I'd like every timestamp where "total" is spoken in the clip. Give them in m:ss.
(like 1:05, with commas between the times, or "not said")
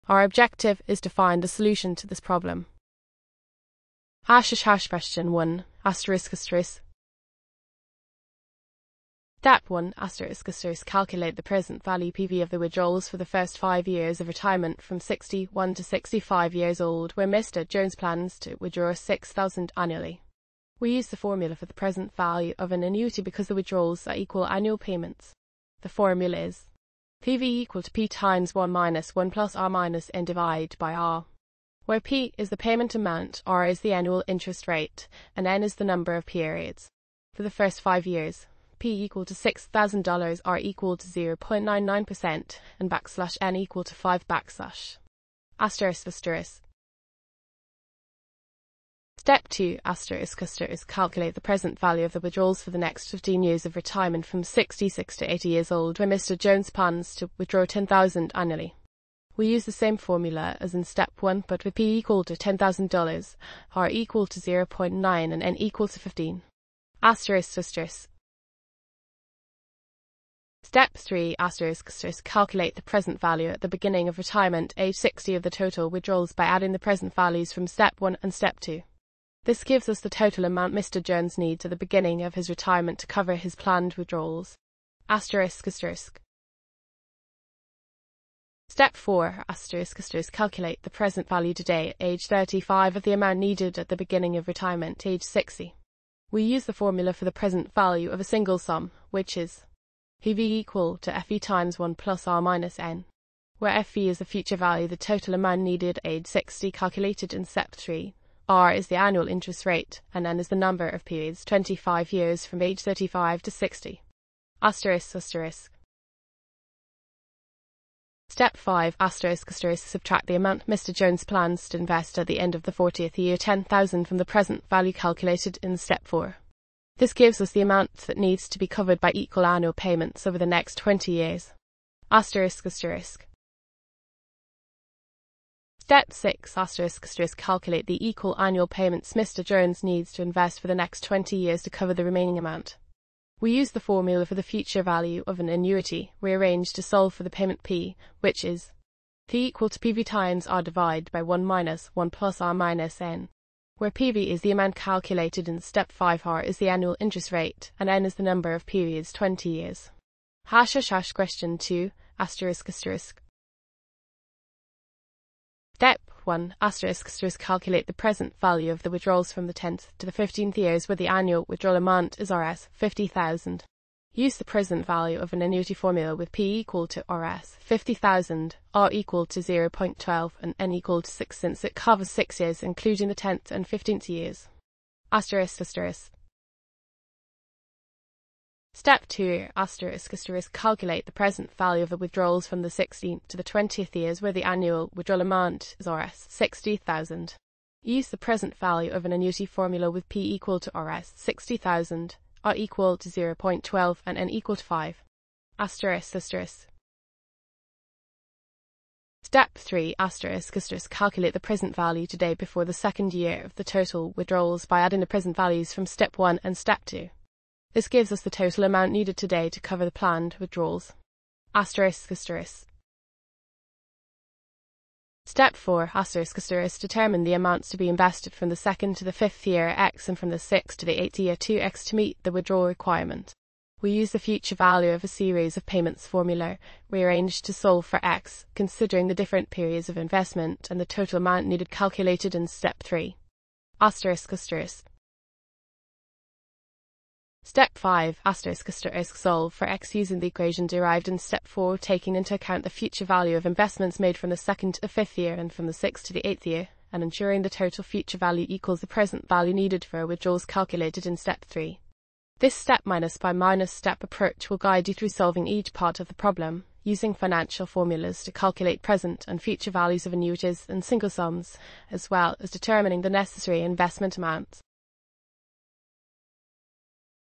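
1:15, 1:20, 1:44, 3:33, 3:38, 4:00, 4:17.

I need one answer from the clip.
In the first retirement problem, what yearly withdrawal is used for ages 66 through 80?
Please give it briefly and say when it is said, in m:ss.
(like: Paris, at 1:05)
$10,000, at 0:57.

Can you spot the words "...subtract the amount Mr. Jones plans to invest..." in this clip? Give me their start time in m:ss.
1:59.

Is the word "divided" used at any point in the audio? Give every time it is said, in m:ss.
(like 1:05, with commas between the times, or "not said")
0:30, 2:30.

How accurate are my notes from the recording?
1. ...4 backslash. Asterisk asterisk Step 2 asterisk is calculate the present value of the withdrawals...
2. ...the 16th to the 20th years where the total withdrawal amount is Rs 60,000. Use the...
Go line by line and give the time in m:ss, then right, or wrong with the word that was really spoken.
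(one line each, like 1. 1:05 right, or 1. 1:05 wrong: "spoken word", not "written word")
1. 0:43 wrong: "5", not "4"
2. 3:12 wrong: "annual", not "total".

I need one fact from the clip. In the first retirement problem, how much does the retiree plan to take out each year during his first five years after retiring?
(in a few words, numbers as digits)
$6,000.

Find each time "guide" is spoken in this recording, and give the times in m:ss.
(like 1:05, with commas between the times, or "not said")
4:24.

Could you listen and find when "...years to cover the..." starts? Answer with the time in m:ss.
2:21.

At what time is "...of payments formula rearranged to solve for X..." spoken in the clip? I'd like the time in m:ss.
3:55.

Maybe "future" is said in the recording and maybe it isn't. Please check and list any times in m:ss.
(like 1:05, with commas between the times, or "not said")
1:44, 2:24, 3:54, 4:12, 4:17, 4:29.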